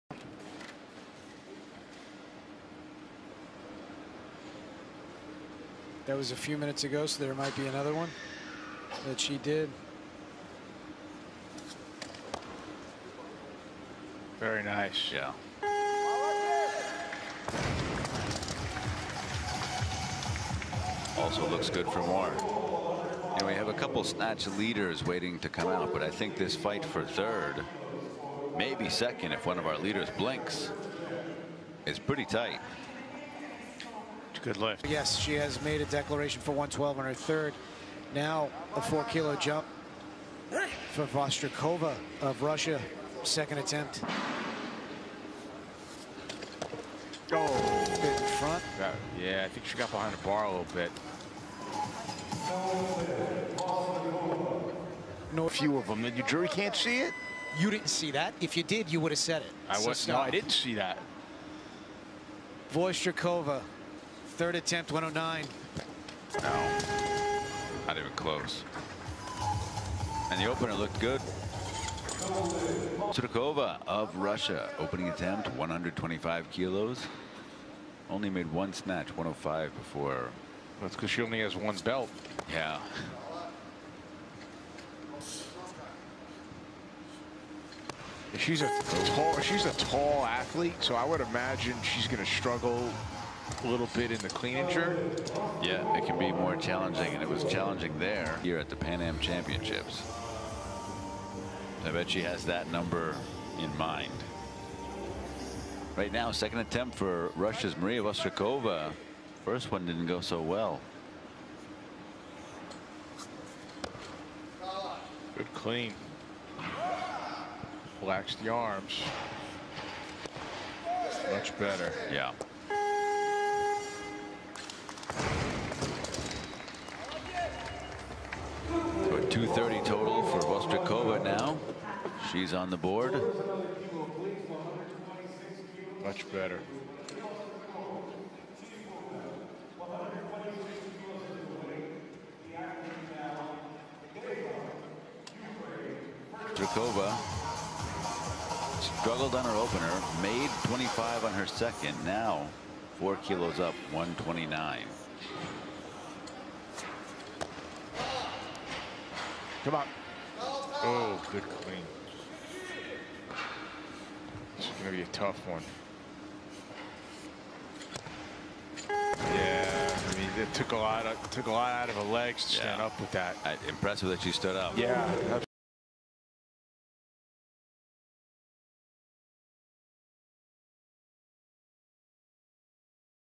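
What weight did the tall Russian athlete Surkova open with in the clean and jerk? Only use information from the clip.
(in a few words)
125 kilos.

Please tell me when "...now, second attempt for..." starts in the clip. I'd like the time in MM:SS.
01:46.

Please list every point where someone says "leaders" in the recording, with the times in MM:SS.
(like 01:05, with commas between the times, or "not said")
00:24, 00:29.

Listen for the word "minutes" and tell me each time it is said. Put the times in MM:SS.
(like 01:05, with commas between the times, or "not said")
00:06.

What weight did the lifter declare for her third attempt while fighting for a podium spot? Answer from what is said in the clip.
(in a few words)
112.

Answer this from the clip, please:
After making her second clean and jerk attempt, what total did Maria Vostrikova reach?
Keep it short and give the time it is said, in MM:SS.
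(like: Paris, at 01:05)
230, at 02:09.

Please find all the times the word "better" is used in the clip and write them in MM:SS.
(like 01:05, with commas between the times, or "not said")
02:01, 02:16.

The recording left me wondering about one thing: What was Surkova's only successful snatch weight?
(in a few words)
105.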